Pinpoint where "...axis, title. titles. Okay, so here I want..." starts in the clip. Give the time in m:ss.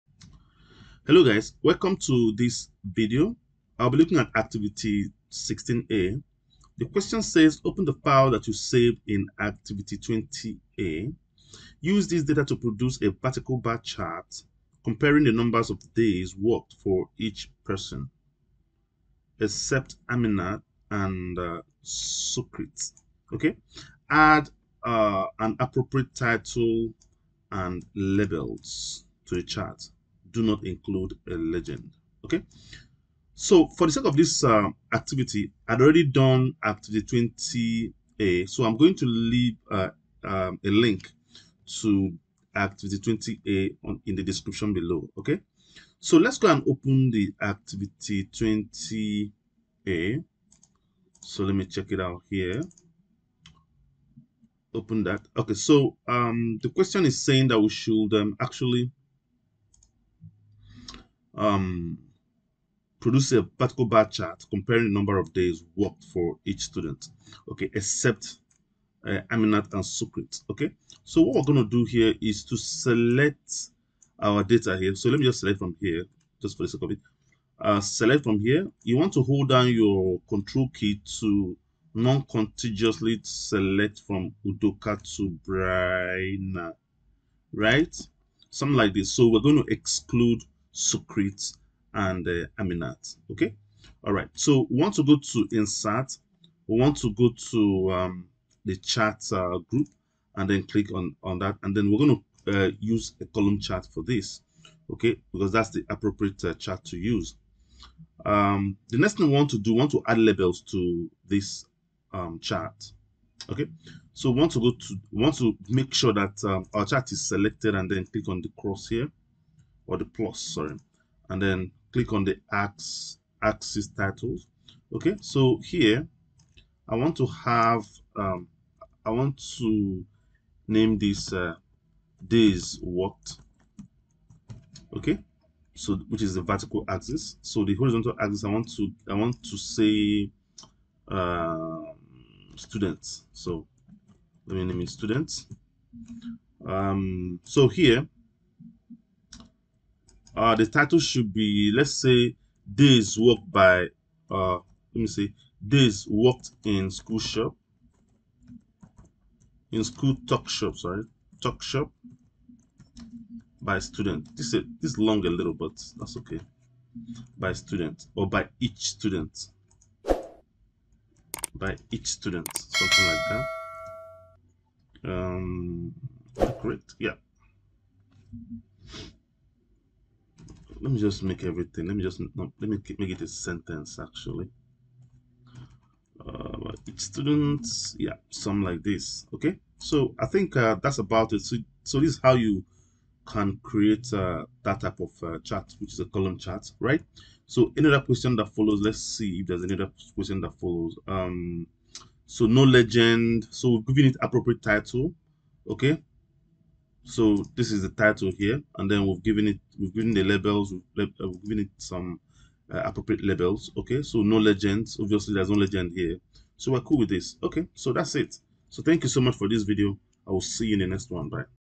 2:02.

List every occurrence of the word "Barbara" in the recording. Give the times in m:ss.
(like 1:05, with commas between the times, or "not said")
not said.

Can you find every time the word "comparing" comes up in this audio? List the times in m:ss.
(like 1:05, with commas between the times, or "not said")
0:14, 1:04.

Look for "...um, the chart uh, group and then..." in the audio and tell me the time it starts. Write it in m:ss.
1:37.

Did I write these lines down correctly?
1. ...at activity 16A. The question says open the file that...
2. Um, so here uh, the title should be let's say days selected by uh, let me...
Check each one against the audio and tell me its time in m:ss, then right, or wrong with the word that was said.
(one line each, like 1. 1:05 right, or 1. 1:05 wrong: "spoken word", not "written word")
1. 0:04 right
2. 2:26 wrong: "worked", not "selected".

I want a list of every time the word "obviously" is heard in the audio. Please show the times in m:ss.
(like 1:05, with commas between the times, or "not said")
3:35.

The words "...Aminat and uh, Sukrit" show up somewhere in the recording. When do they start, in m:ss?
0:20.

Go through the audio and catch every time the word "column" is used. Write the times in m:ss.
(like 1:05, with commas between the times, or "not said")
1:43, 3:16.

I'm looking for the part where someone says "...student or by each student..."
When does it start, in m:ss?
2:47.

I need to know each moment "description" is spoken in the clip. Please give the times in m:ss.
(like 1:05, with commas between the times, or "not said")
0:44.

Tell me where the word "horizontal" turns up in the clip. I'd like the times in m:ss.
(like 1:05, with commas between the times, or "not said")
2:17.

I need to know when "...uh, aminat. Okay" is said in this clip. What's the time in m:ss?
1:32.